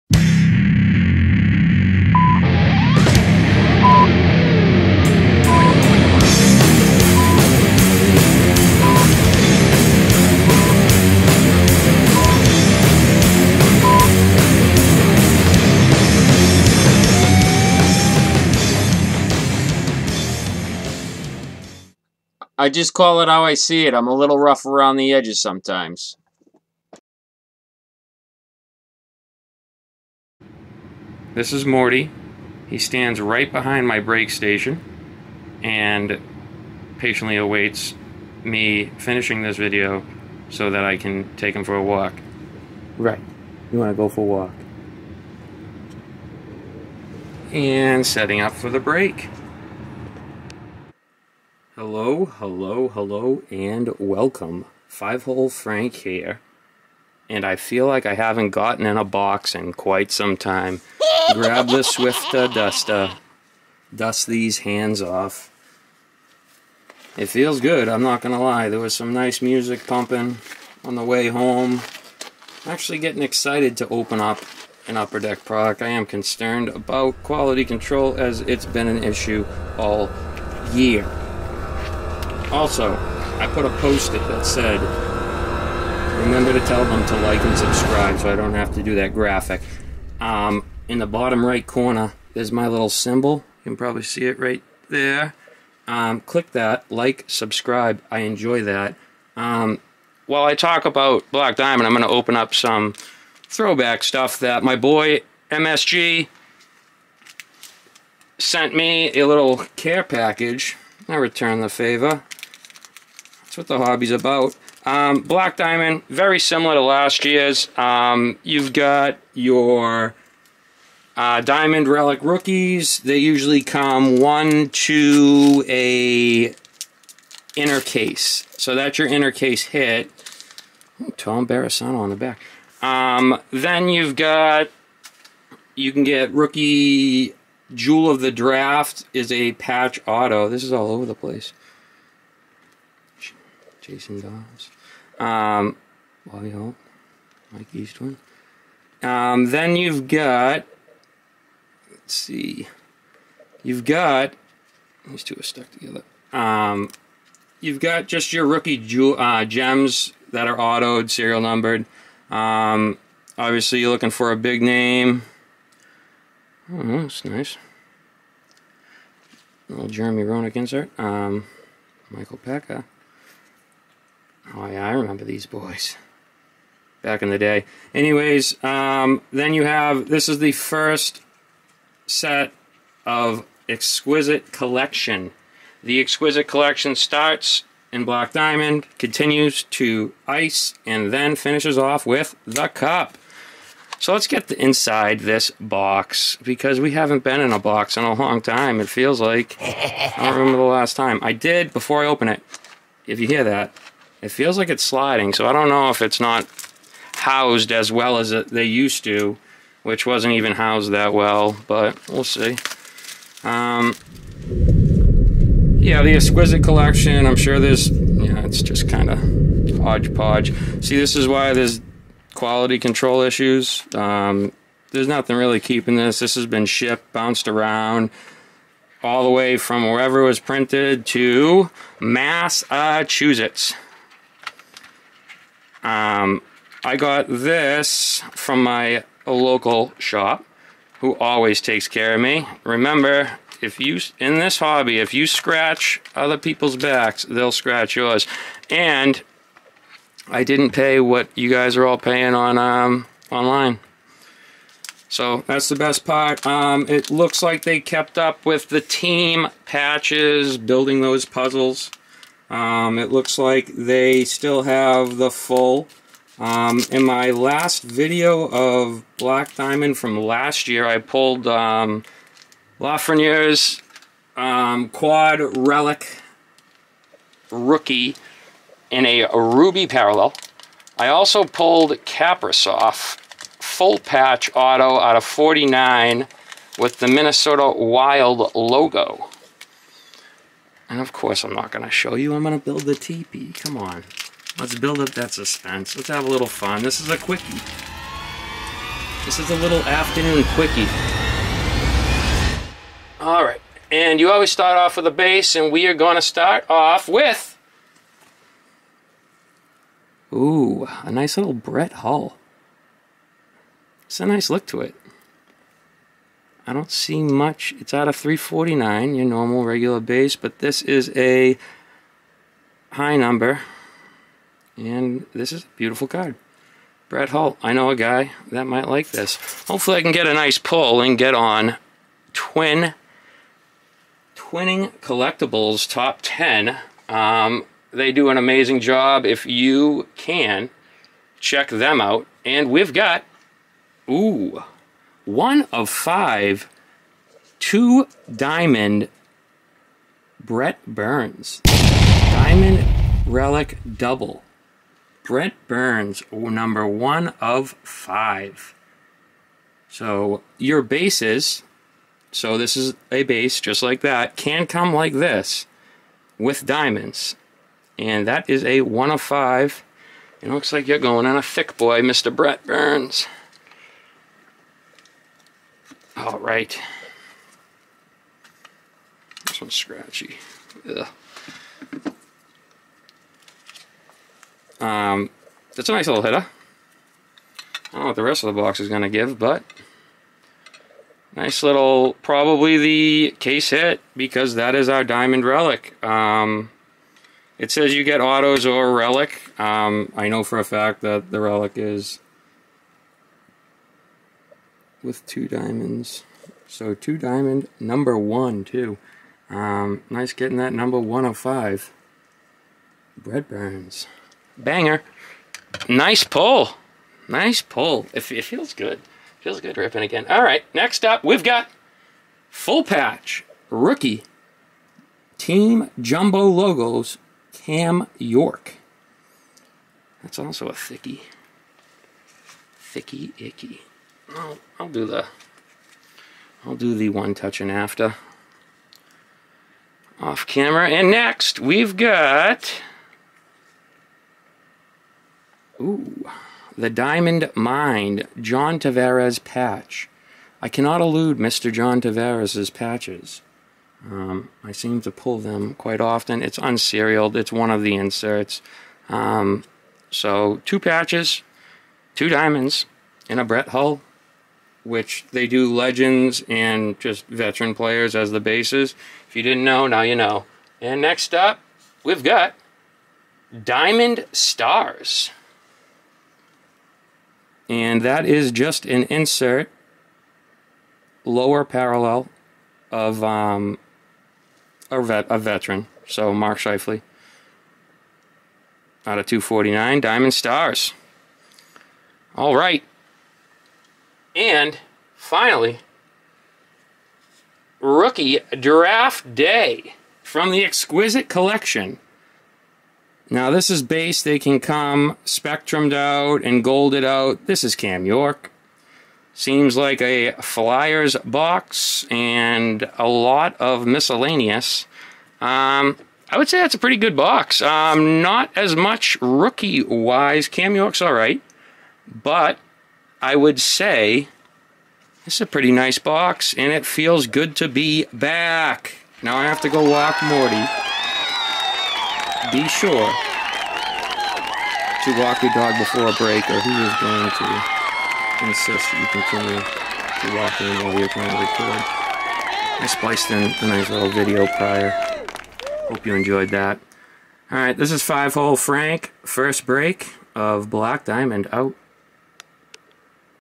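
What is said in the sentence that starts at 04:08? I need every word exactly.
And I didn't pay what you guys are all paying on um, online.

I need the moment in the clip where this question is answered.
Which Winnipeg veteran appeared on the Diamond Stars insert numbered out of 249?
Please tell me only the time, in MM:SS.
08:06.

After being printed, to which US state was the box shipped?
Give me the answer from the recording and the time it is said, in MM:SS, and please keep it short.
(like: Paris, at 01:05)
Massachusetts, at 03:51.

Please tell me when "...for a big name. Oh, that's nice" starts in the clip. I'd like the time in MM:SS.
02:44.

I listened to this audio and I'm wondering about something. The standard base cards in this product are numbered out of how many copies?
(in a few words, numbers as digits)
349.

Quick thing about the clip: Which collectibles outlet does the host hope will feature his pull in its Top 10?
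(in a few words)
Twin Twinning Collectibles.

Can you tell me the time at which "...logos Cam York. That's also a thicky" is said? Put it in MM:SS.
07:06.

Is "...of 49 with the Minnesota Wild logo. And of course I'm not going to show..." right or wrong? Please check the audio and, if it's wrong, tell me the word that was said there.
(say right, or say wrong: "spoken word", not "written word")
right.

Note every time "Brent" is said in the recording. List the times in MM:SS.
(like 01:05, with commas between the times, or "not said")
05:50, 05:55, 06:12, 06:53.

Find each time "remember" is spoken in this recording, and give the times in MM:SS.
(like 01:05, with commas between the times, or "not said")
01:26, 02:54, 03:20, 04:02.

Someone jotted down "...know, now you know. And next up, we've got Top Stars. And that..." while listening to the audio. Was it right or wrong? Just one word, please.
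wrong.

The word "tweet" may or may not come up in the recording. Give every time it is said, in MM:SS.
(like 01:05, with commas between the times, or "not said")
not said.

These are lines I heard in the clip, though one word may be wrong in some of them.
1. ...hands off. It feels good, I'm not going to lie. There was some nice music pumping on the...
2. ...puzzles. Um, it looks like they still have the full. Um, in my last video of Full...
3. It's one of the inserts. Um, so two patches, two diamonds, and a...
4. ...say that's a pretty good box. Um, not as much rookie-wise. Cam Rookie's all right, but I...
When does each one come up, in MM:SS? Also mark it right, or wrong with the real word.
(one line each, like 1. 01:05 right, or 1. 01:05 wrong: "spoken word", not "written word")
1. 01:04 right
2. 04:21 wrong: "Black", not "Full"
3. 07:37 right
4. 08:36 wrong: "York", not "Rookie".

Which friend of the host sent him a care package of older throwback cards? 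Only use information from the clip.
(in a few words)
MSG.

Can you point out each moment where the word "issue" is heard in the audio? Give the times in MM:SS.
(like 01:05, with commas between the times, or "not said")
01:19, 03:43.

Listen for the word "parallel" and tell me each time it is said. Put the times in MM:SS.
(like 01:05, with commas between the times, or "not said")
04:39, 08:01.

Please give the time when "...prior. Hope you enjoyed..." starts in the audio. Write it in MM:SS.
09:04.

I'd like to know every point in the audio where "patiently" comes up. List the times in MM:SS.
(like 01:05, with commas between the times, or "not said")
00:36.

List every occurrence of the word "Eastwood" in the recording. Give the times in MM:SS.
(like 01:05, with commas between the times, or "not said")
02:27.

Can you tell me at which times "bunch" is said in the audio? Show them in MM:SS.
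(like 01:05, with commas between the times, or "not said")
not said.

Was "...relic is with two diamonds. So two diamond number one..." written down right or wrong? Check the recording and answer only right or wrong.
right.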